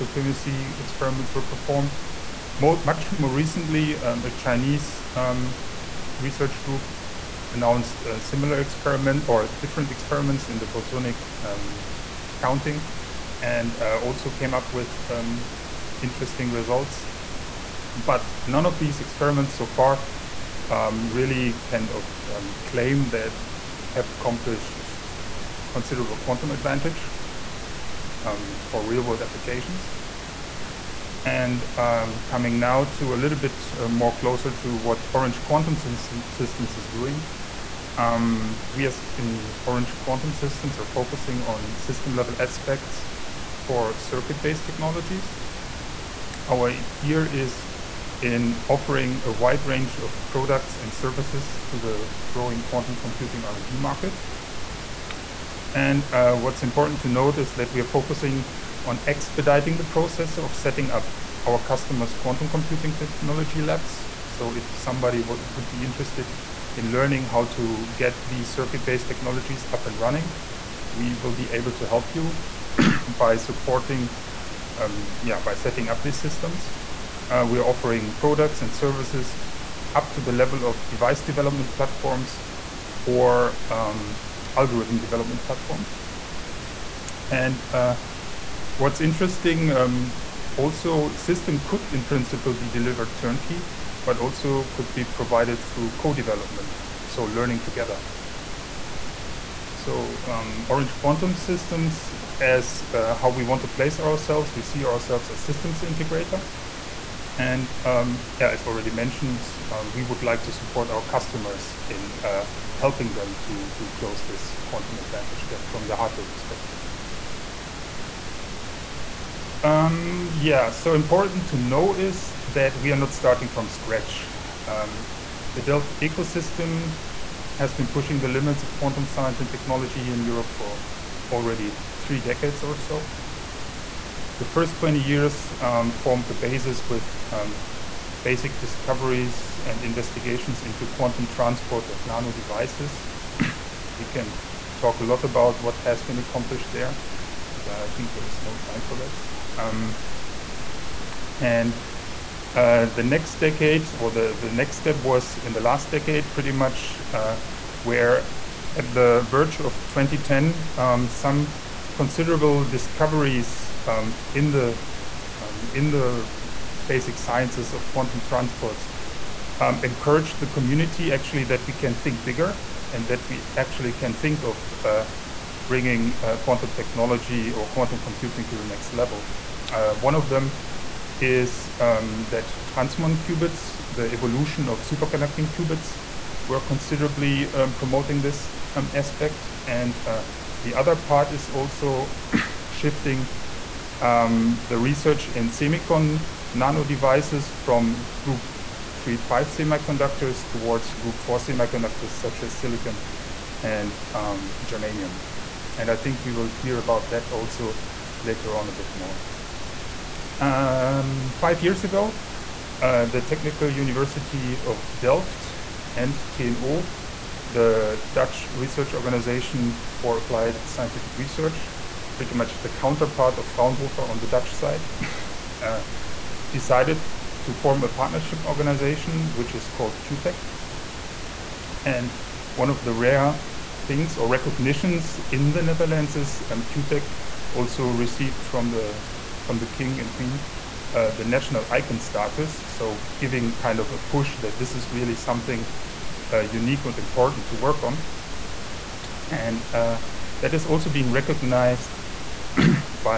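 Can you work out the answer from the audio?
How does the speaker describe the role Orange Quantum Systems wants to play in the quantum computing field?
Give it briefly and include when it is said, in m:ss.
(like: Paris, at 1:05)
Systems integrator, at 1:45.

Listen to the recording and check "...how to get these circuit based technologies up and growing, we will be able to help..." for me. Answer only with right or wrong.
wrong.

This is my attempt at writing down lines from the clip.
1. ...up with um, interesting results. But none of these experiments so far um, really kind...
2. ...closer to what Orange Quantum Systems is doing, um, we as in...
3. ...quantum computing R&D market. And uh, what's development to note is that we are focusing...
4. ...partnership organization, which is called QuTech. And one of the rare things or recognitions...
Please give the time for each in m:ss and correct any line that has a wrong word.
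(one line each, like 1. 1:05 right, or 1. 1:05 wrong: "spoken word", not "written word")
1. 0:14 right
2. 0:34 right
3. 0:52 wrong: "important", not "development"
4. 3:47 right.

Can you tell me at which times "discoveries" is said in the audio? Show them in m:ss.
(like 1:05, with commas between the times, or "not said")
2:18, 2:42.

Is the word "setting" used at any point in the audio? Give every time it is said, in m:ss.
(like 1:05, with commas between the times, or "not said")
1:00, 1:15.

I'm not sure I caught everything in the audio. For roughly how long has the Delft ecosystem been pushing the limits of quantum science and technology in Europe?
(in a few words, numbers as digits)
3 decades.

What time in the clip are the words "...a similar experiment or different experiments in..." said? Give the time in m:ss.
0:08.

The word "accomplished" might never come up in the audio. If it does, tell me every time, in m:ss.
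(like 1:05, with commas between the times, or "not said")
0:24, 2:26.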